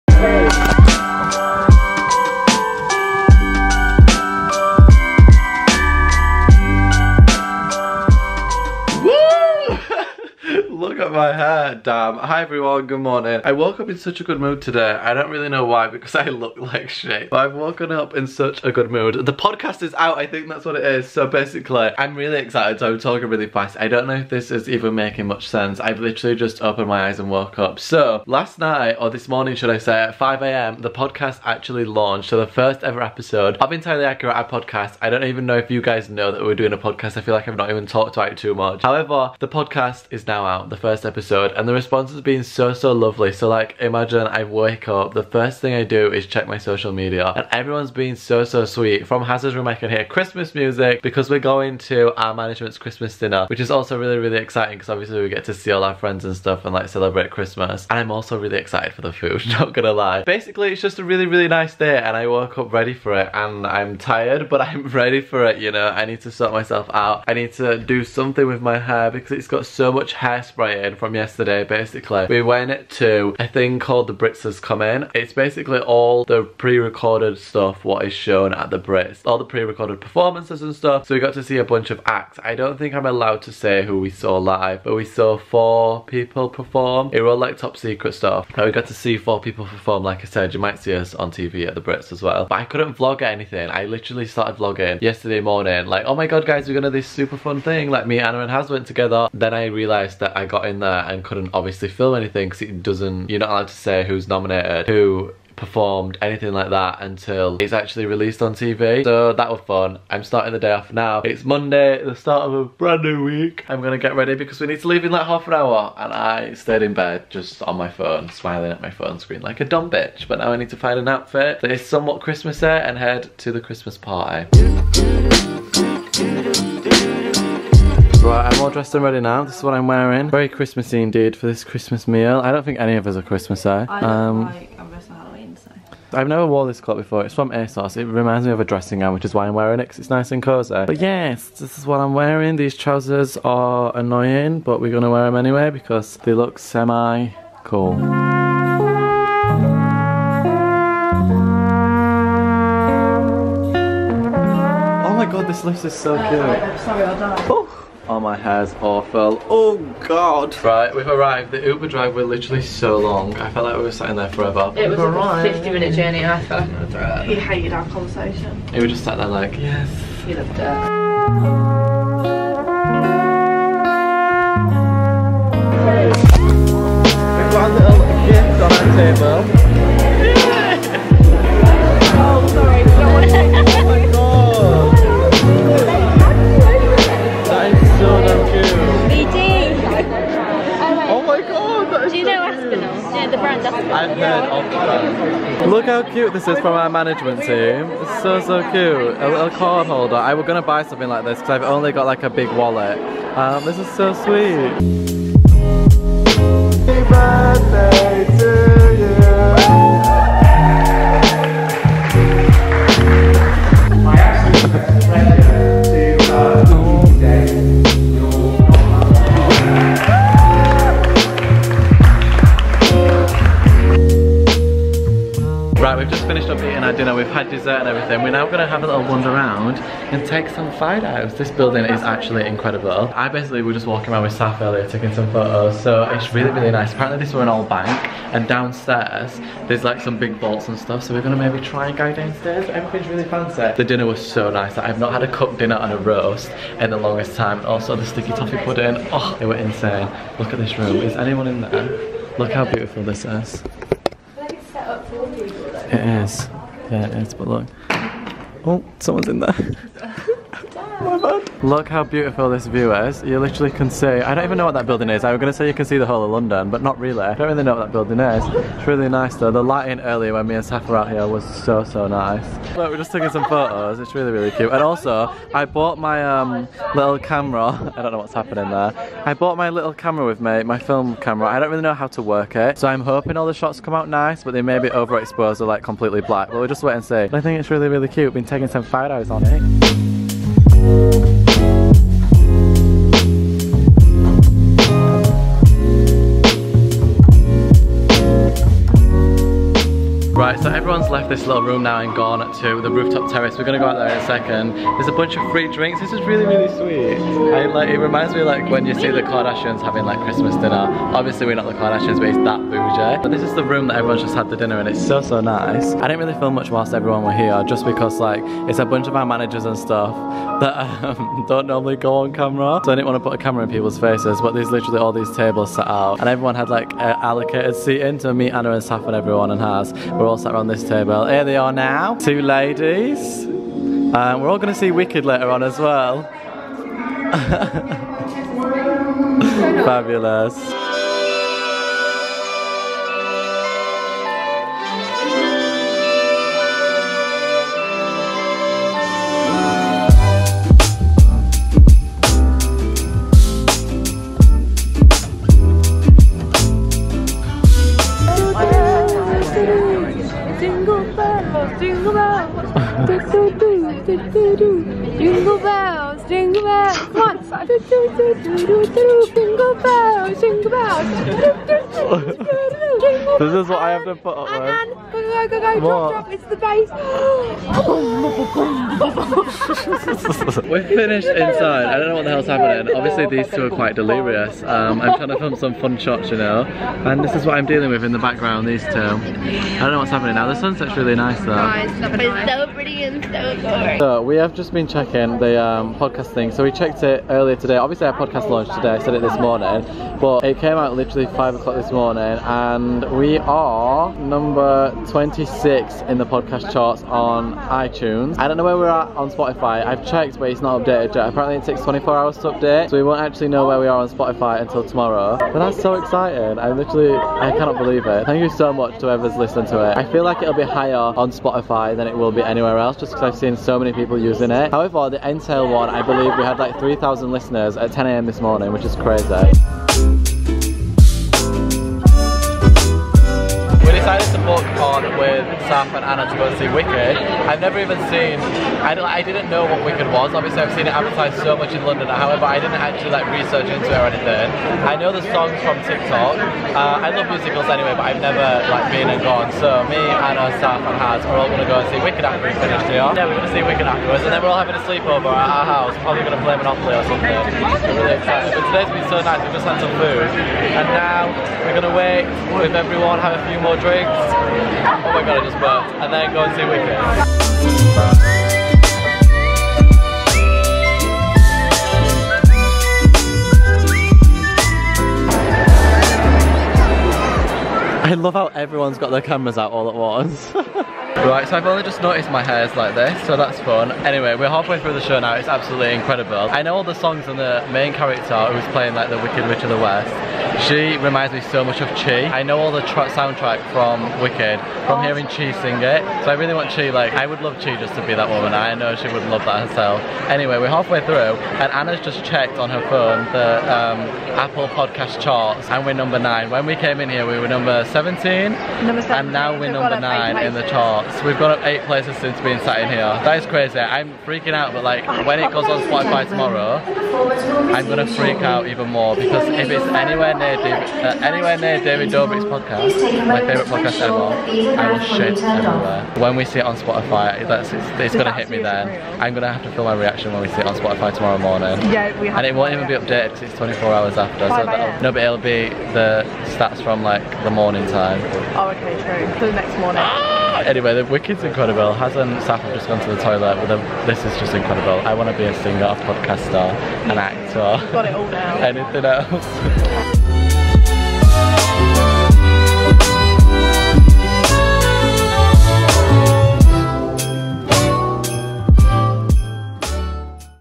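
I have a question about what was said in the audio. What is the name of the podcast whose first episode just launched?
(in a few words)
Entirely Accurate.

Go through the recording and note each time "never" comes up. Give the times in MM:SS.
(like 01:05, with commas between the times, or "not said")
02:16, 07:17, 07:28.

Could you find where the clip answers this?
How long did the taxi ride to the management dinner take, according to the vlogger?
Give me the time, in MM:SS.
02:45.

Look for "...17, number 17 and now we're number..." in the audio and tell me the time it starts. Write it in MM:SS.
08:27.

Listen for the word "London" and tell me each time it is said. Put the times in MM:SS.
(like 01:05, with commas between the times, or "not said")
04:26, 07:21.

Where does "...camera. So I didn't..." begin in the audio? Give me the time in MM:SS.
05:22.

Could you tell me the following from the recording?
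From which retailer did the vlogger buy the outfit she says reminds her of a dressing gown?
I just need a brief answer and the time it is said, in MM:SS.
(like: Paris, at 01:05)
ASOS, at 02:17.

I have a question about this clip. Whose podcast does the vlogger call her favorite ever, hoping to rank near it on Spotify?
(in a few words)
David Dobrik.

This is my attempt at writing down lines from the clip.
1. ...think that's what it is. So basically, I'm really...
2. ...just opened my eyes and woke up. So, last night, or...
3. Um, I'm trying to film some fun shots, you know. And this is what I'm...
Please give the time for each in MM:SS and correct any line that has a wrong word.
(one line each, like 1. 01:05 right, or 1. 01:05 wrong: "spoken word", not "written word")
1. 00:20 right
2. 00:26 right
3. 06:24 right.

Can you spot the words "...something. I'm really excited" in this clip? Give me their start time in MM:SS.
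07:37.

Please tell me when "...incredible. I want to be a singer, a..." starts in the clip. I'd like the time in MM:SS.
09:04.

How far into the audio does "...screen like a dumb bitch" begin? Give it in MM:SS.
01:59.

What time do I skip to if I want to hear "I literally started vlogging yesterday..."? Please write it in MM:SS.
01:33.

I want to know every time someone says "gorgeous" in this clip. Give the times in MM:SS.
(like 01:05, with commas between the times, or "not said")
not said.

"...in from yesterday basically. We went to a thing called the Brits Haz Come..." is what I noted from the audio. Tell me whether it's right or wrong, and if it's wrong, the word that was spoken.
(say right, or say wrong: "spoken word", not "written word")
right.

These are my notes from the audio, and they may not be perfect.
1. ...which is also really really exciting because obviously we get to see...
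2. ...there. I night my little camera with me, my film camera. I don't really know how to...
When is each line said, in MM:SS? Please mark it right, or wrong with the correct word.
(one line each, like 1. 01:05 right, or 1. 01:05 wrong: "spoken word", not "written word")
1. 00:53 right
2. 04:38 wrong: "bought", not "night".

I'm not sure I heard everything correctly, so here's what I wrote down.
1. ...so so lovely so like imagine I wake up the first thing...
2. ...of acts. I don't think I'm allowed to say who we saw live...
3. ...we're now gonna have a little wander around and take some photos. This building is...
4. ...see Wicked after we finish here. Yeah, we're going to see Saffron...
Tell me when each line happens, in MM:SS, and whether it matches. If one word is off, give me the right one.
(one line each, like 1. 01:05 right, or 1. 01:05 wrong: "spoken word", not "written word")
1. 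00:42 right
2. 01:21 right
3. 03:48 right
4. 07:31 wrong: "Wicked", not "Saffron".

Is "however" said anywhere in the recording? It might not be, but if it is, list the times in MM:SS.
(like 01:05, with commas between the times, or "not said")
00:38, 07:04, 07:22.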